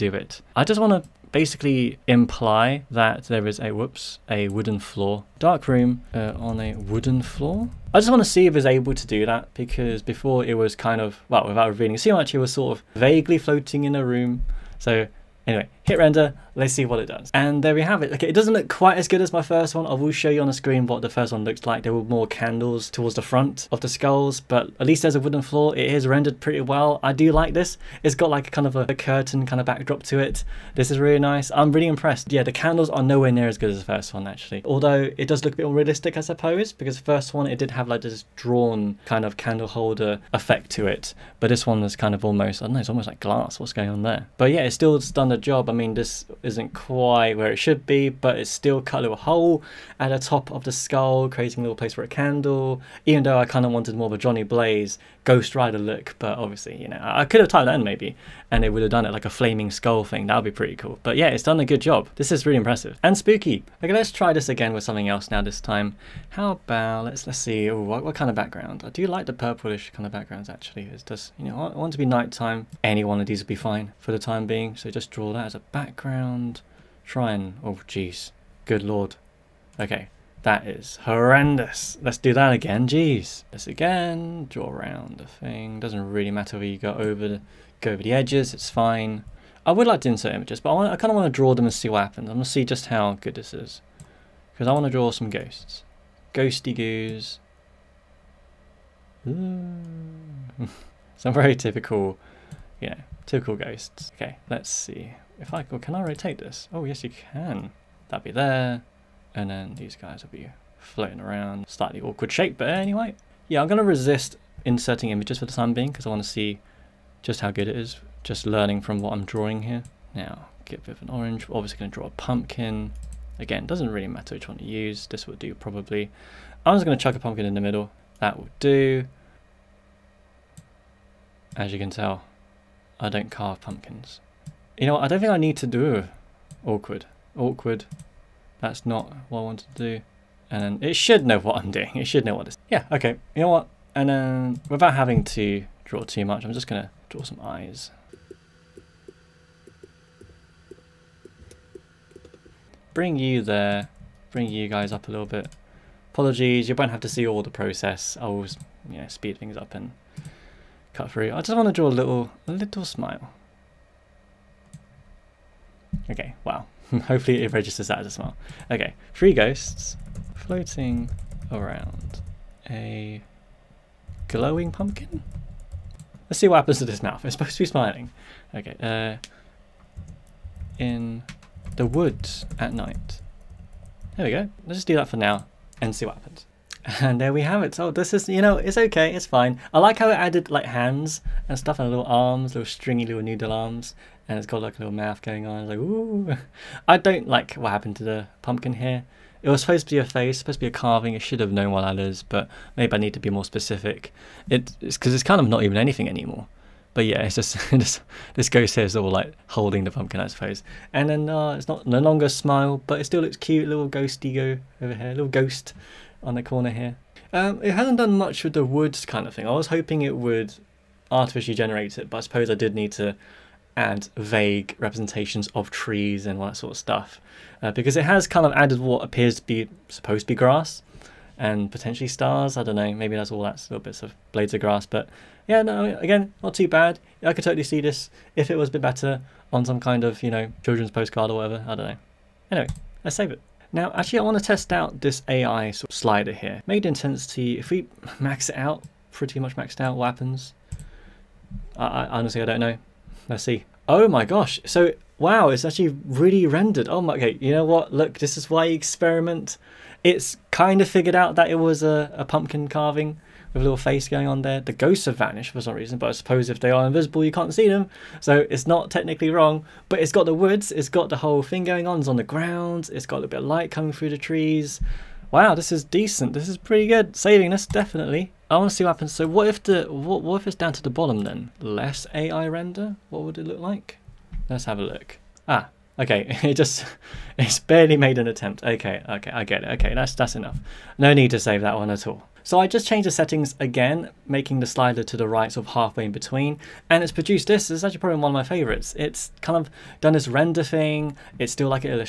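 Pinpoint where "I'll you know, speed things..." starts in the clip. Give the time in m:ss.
2:38.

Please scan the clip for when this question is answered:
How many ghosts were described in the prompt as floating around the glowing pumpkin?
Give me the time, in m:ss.
2:49.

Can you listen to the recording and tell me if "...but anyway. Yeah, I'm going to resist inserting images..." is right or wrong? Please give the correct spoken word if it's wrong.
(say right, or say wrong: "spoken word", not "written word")
right.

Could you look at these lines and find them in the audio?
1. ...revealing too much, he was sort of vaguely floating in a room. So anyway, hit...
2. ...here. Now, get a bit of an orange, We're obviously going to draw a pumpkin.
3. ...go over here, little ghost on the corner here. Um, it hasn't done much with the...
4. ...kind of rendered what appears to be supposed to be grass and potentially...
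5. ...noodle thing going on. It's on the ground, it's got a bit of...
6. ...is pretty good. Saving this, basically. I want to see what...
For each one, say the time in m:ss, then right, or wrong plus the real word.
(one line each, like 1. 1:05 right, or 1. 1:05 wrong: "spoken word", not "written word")
1. 0:11 right
2. 1:59 right
3. 3:34 right
4. 3:48 wrong: "added", not "rendered"
5. 4:31 wrong: "whole", not "noodle"
6. 4:36 wrong: "definitely", not "basically".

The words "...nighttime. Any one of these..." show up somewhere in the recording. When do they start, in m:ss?
1:12.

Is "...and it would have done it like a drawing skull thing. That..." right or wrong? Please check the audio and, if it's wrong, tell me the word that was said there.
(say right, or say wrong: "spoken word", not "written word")
wrong: "flaming", not "drawing".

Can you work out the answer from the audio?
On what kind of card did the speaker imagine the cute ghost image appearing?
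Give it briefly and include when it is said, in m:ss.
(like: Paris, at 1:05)
children's postcard, at 4:00.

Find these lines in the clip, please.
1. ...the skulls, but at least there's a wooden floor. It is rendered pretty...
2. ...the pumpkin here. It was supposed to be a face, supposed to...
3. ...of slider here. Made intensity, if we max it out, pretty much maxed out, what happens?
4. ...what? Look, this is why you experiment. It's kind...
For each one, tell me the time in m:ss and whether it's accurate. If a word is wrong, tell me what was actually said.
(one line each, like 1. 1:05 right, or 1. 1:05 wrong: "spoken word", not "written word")
1. 0:23 right
2. 3:18 right
3. 4:05 right
4. 4:17 right.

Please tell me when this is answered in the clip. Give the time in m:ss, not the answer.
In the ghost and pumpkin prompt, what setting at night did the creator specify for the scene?
3:00.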